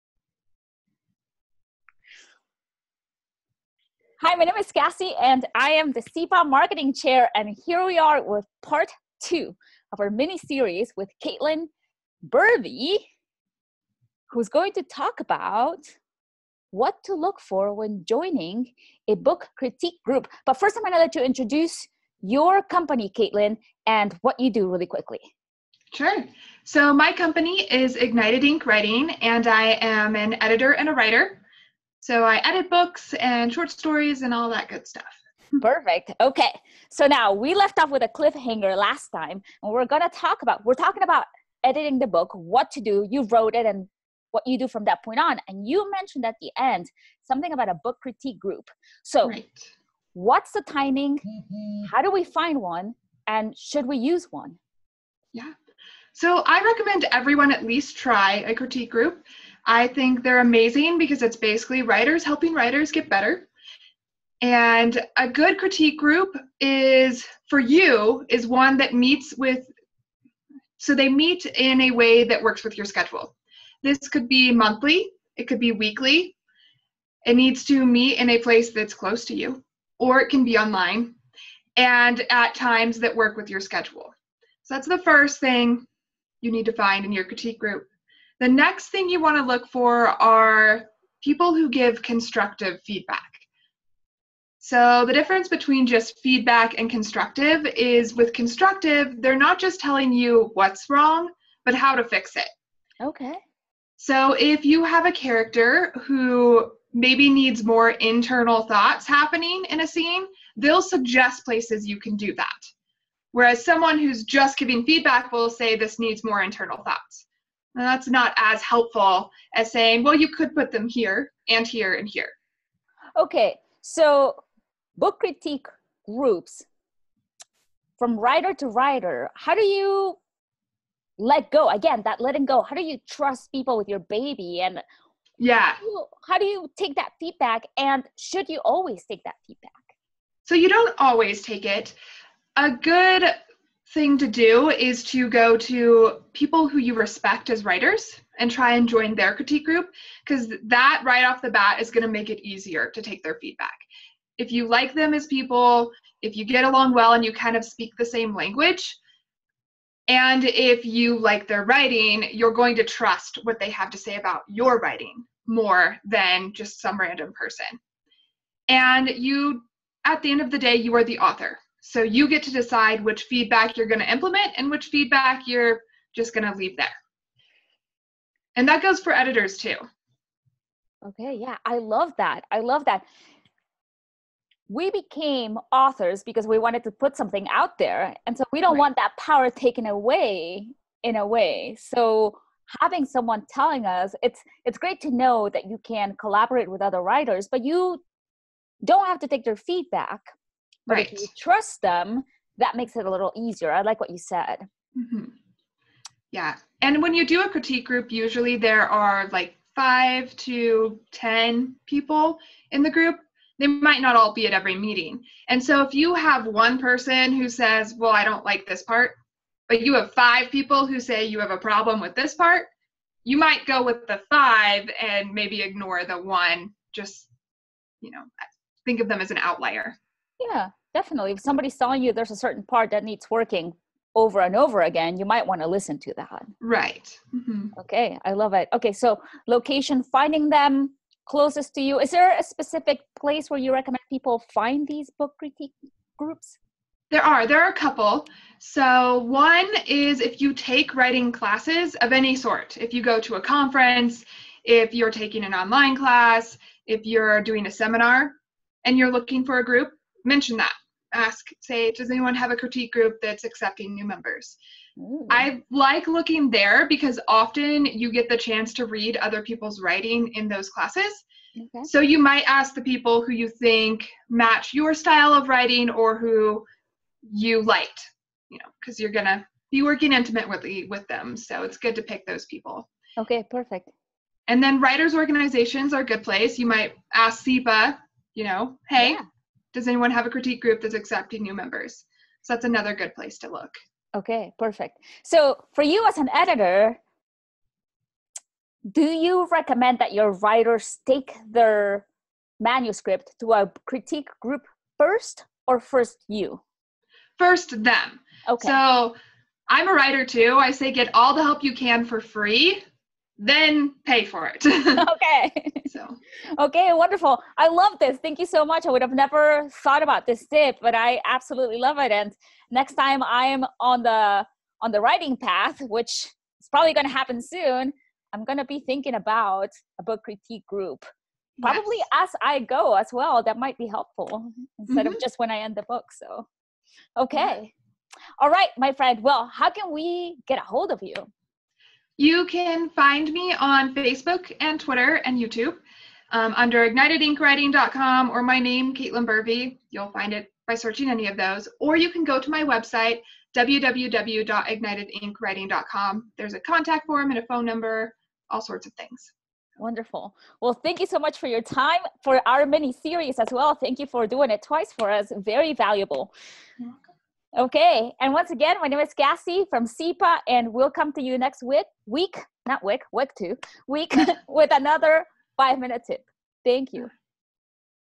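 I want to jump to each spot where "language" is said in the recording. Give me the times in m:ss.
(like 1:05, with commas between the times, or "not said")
2:38.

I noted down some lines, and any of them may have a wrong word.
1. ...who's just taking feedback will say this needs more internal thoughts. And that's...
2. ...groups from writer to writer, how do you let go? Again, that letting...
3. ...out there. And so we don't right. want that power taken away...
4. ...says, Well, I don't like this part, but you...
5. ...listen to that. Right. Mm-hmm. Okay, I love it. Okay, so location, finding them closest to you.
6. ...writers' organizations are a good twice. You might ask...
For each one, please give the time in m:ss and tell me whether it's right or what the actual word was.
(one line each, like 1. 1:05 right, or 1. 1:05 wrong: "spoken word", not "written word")
1. 1:53 wrong: "giving", not "taking"
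2. 2:06 right
3. 3:07 right
4. 3:37 right
5. 3:55 right
6. 4:44 wrong: "place", not "twice".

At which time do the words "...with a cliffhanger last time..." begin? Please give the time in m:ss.
0:37.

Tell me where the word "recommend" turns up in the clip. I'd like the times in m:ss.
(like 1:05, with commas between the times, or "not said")
0:56, 4:03, 4:59.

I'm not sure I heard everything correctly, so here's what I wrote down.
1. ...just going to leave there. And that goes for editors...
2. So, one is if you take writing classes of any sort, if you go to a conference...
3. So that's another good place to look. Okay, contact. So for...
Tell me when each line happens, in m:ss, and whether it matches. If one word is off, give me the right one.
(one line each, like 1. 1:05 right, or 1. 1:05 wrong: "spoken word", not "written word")
1. 2:56 right
2. 4:08 right
3. 4:52 wrong: "perfect", not "contact".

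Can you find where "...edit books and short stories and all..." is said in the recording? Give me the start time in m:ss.
0:32.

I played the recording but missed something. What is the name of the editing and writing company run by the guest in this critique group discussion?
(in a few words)
Ignited Ink Writing.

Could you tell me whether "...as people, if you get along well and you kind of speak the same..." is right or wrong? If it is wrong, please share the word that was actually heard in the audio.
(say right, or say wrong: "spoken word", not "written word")
right.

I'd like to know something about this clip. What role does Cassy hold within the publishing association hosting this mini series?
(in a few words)
Marketing Chair.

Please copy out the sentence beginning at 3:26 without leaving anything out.
And when you do a critique group, usually there are like five to 10 people in the group.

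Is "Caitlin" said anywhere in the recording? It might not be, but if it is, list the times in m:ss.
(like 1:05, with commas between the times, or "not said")
0:11, 0:23, 5:48.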